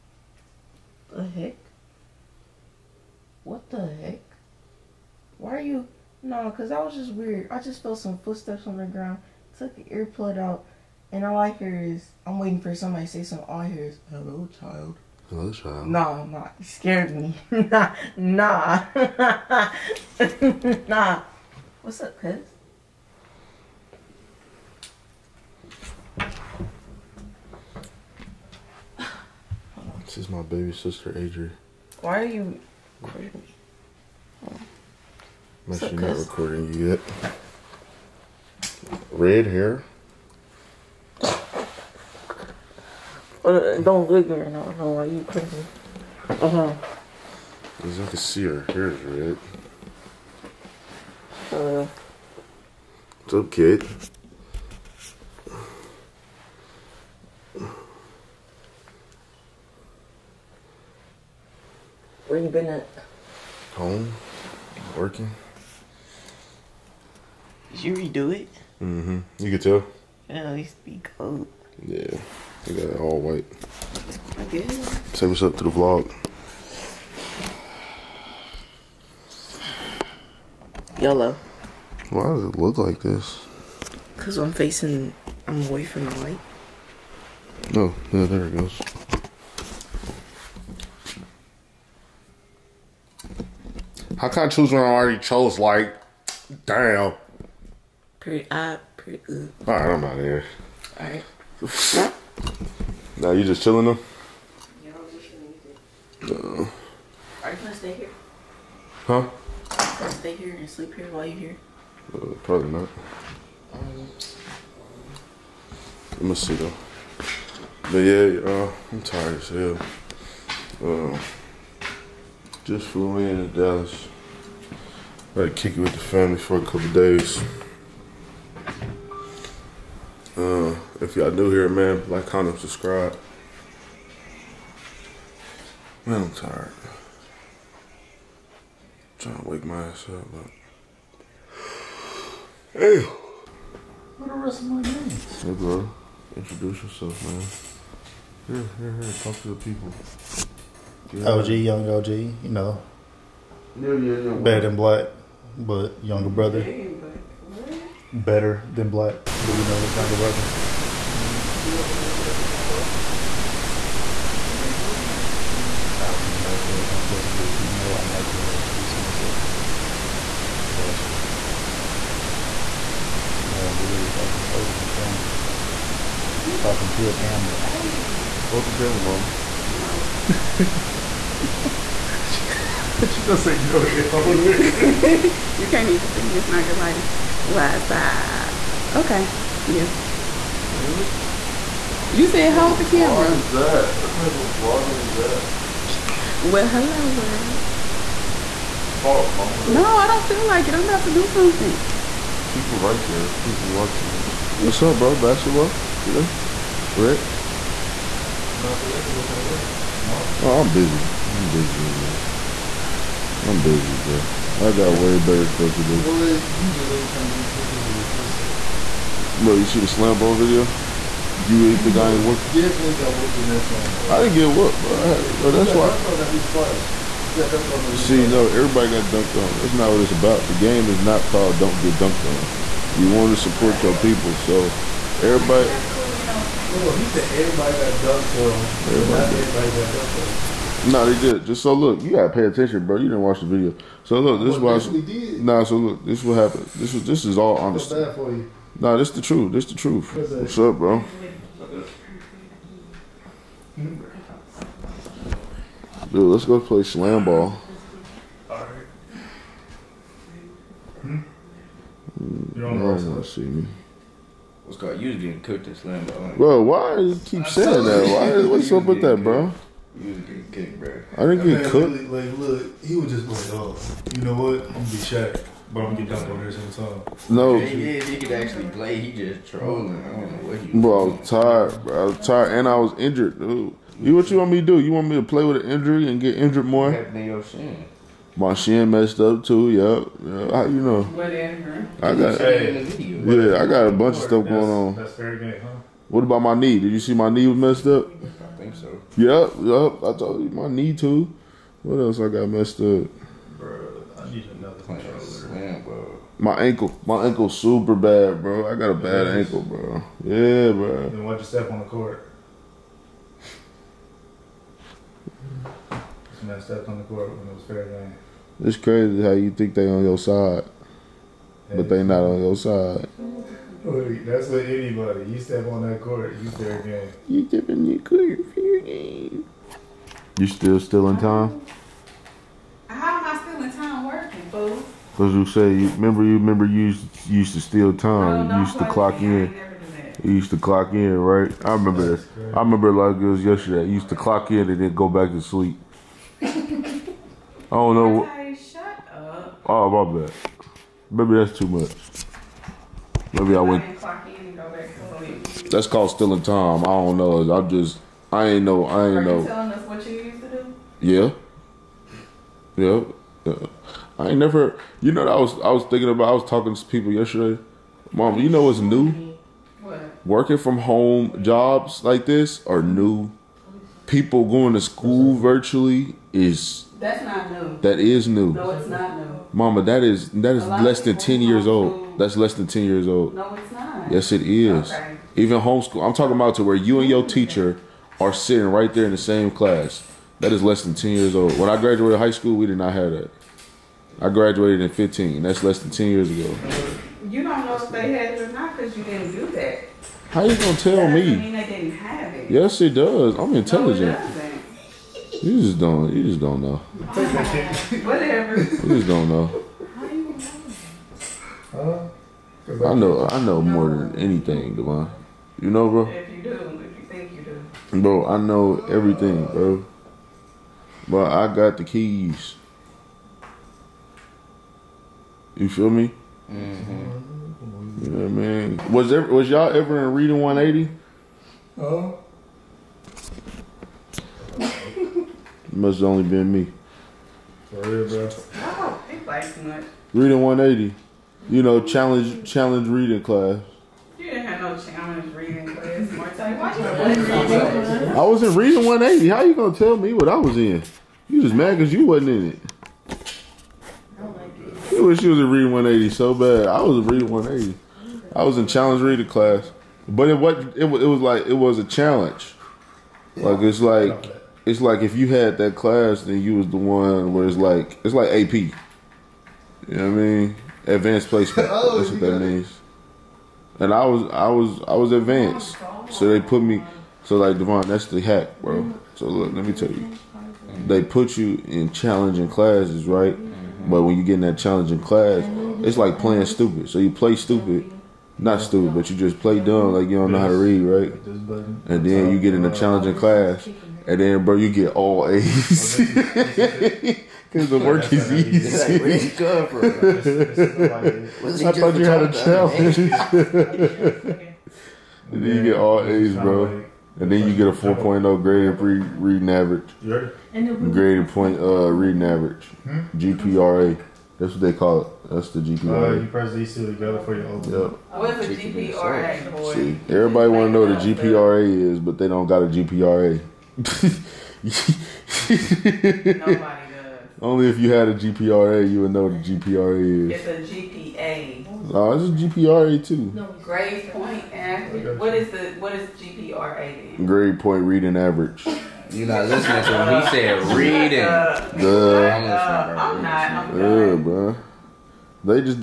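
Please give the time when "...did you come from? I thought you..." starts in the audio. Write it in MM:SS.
08:19.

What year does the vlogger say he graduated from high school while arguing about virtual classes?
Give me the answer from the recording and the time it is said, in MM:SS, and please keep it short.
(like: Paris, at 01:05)
2015, at 06:34.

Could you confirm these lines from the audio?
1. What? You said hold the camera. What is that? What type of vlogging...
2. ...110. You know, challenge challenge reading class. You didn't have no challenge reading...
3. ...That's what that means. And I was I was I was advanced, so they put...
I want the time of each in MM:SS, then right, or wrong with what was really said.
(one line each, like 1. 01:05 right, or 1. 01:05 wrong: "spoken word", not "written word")
1. 03:10 right
2. 07:20 wrong: "180", not "110"
3. 07:51 right.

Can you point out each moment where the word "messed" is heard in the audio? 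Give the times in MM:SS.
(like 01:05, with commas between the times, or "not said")
04:48, 04:57, 05:02, 05:16.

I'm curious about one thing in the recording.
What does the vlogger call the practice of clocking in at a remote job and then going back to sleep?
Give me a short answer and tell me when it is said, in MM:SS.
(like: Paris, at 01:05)
Stealing time, at 05:56.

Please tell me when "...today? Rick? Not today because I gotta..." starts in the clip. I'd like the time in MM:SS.
03:25.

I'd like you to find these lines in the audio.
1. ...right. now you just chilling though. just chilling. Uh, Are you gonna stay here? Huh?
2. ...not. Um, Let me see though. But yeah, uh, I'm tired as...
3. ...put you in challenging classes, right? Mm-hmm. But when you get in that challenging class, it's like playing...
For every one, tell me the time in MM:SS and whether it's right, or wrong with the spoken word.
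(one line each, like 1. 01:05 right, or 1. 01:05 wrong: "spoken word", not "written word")
1. 01:41 right
2. 01:52 right
3. 08:01 right.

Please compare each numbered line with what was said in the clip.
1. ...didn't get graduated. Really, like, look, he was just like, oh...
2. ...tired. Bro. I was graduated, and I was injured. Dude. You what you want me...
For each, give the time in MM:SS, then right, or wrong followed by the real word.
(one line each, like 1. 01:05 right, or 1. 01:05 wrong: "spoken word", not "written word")
1. 04:31 wrong: "cooked", not "graduated"
2. 04:41 wrong: "tired", not "graduated".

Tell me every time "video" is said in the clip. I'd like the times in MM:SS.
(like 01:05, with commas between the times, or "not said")
03:40, 04:03.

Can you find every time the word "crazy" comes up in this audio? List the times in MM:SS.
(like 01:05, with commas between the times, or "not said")
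00:45, 05:18.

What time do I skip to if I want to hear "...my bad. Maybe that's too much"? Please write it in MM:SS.
05:49.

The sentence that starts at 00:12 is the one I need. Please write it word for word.
I'm waiting for somebody to say something.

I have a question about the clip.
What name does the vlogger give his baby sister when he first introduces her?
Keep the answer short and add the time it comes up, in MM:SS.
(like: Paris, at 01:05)
Adri, at 00:31.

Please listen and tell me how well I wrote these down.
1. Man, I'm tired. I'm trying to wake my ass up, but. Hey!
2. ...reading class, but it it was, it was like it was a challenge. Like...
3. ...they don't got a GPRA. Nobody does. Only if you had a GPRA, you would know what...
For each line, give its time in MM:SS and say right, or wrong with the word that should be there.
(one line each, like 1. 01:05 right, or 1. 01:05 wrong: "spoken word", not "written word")
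1. 02:16 right
2. 07:39 right
3. 08:42 right.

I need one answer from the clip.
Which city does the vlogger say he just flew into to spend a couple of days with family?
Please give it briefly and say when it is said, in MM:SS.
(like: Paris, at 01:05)
Dallas, at 02:03.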